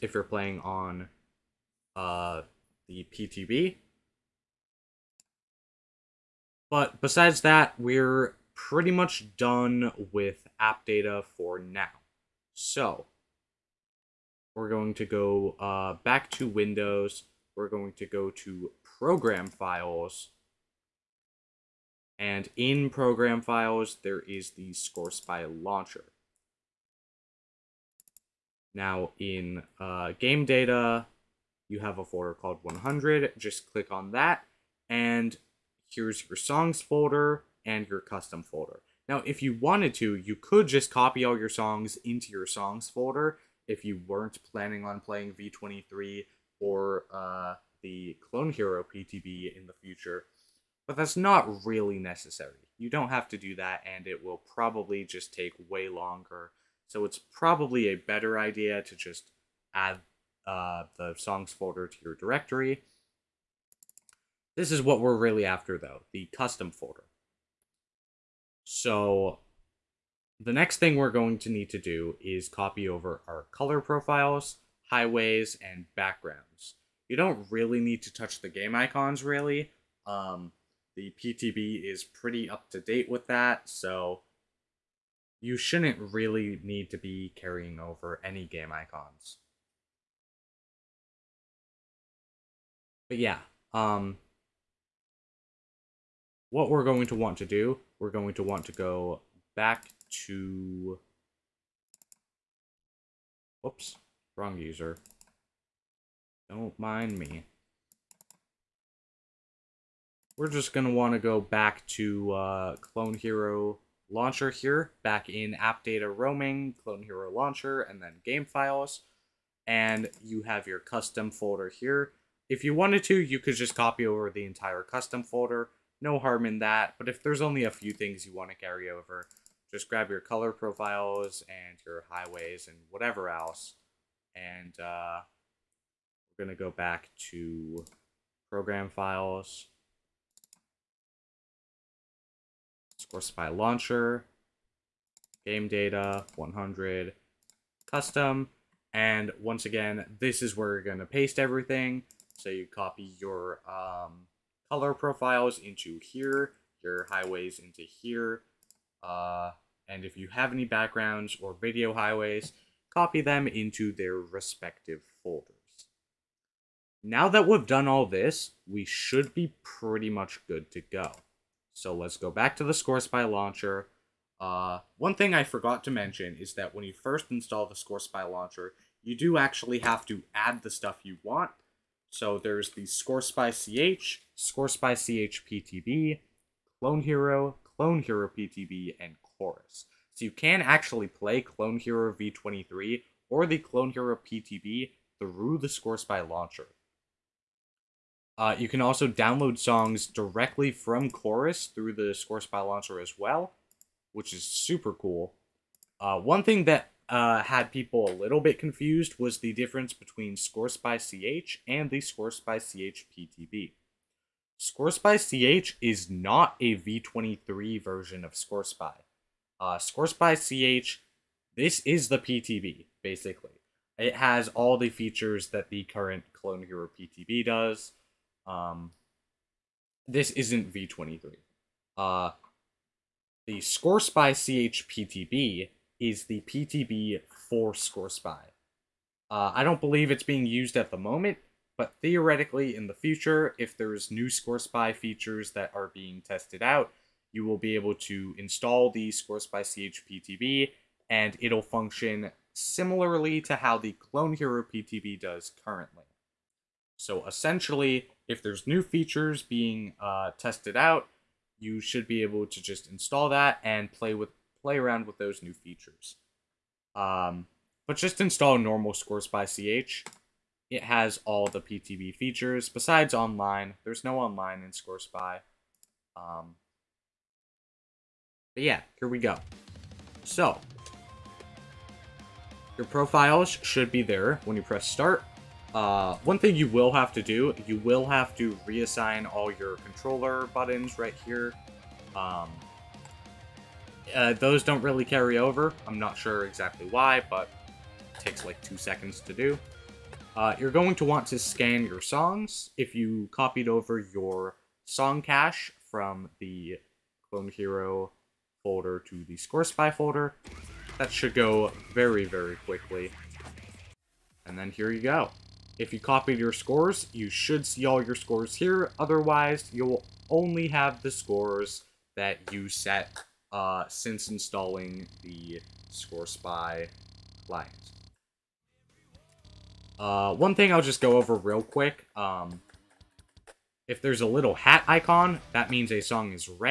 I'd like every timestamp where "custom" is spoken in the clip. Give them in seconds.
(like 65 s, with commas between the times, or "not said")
38 s, 66 s, 120 s, 124 s, 147 s.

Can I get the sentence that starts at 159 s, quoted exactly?
Uh, and if you have any backgrounds or video highways, copy them into their respective folders.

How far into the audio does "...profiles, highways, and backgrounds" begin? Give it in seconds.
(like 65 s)
73 s.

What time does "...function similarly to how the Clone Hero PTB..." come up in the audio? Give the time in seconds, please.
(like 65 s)
251 s.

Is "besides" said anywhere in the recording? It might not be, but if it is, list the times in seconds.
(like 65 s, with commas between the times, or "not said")
7 s, 272 s.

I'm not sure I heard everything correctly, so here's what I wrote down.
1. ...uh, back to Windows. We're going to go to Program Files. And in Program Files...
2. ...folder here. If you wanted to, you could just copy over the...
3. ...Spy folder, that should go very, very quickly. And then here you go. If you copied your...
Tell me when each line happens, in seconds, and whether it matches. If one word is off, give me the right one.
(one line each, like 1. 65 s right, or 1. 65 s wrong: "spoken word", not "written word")
1. 15 s right
2. 121 s right
3. 309 s right.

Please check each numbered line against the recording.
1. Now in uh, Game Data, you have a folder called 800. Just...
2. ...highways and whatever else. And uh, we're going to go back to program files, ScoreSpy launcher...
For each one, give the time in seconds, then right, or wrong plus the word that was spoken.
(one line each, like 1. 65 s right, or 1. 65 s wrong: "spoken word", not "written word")
1. 28 s wrong: "100", not "800"
2. 132 s right.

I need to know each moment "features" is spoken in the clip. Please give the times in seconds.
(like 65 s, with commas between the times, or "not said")
224 s, 244 s, 258 s, 265 s, 272 s.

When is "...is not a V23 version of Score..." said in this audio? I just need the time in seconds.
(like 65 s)
215 s.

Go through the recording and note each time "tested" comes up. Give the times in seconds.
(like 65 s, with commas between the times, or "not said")
246 s, 260 s.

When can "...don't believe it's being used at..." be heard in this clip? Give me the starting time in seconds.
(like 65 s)
239 s.